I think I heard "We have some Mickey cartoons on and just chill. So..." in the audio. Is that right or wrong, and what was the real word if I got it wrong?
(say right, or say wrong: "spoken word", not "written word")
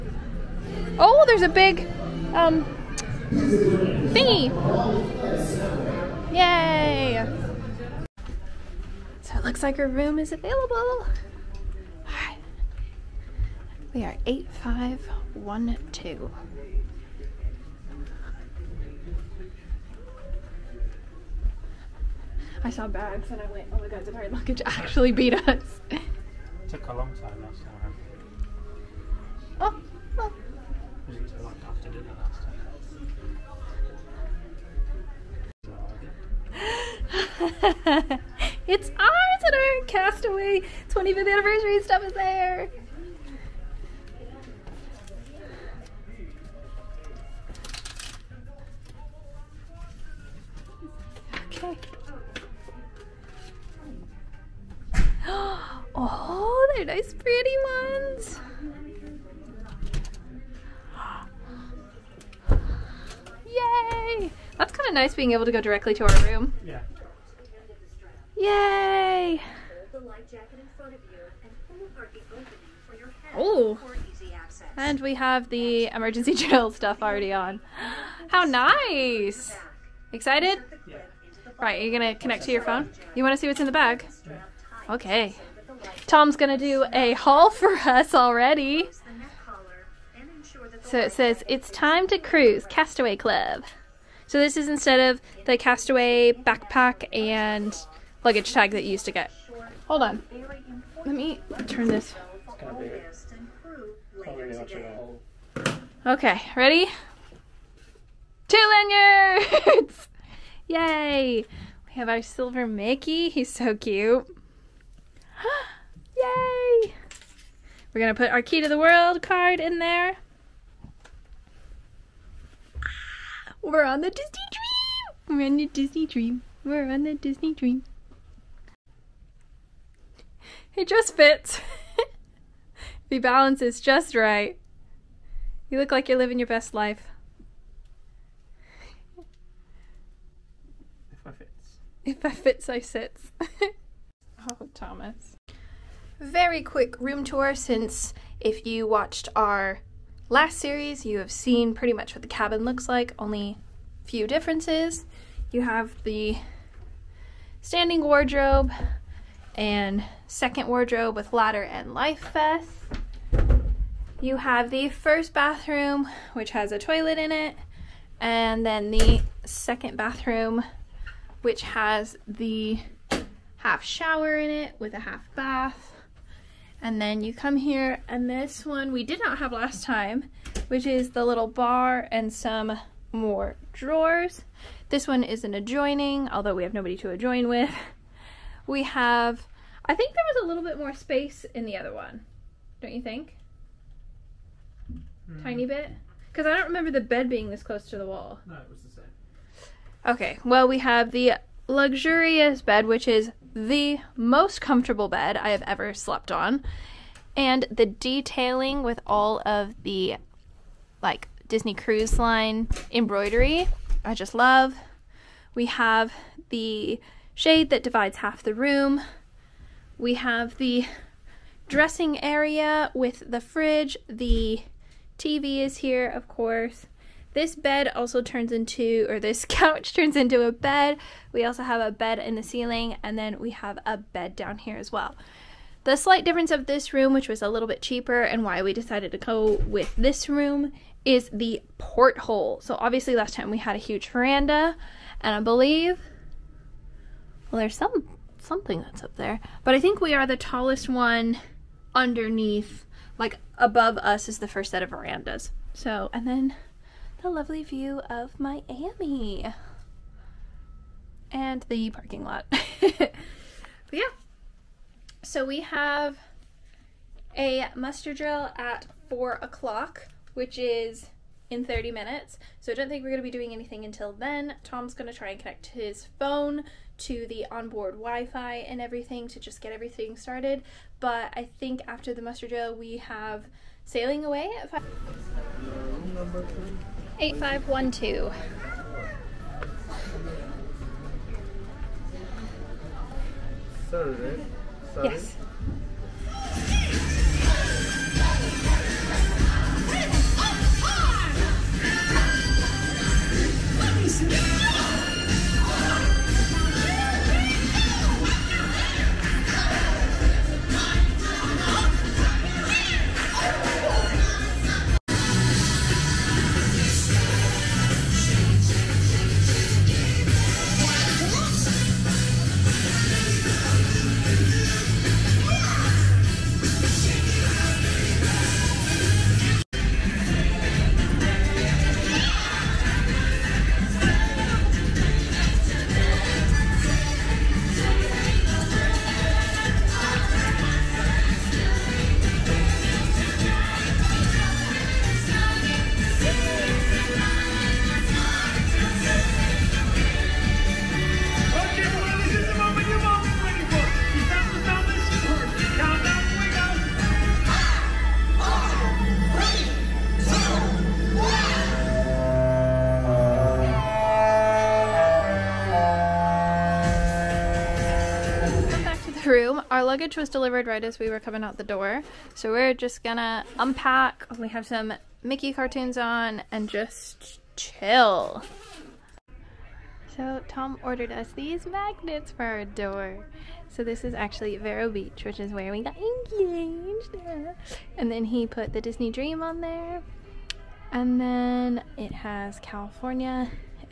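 right.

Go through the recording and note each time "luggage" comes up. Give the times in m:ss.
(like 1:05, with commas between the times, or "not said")
0:24, 1:38, 6:09.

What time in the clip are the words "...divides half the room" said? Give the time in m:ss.
3:37.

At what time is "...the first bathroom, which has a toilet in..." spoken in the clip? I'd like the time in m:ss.
2:44.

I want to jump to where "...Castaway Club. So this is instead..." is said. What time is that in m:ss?
1:32.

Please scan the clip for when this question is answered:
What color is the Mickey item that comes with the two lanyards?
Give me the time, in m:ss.
1:52.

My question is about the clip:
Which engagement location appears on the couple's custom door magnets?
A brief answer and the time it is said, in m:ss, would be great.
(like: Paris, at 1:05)
Vero Beach, at 6:24.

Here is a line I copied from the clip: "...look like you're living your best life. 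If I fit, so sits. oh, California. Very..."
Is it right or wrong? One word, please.
wrong.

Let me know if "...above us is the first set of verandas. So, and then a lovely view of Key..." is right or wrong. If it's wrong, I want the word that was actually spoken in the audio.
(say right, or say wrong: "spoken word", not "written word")
wrong: "Miami", not "Key".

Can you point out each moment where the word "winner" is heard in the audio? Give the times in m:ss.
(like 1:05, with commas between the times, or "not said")
not said.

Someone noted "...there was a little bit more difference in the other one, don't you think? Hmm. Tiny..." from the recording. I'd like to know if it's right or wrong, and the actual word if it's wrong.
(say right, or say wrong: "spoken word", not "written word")
wrong: "space", not "difference".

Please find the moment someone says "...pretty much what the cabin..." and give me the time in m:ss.
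2:31.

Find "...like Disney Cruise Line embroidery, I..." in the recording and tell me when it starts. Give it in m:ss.
3:31.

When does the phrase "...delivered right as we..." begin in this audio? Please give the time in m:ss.
6:10.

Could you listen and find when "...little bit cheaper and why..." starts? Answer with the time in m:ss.
3:57.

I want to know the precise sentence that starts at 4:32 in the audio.
So I don't think we're going to be doing anything until then.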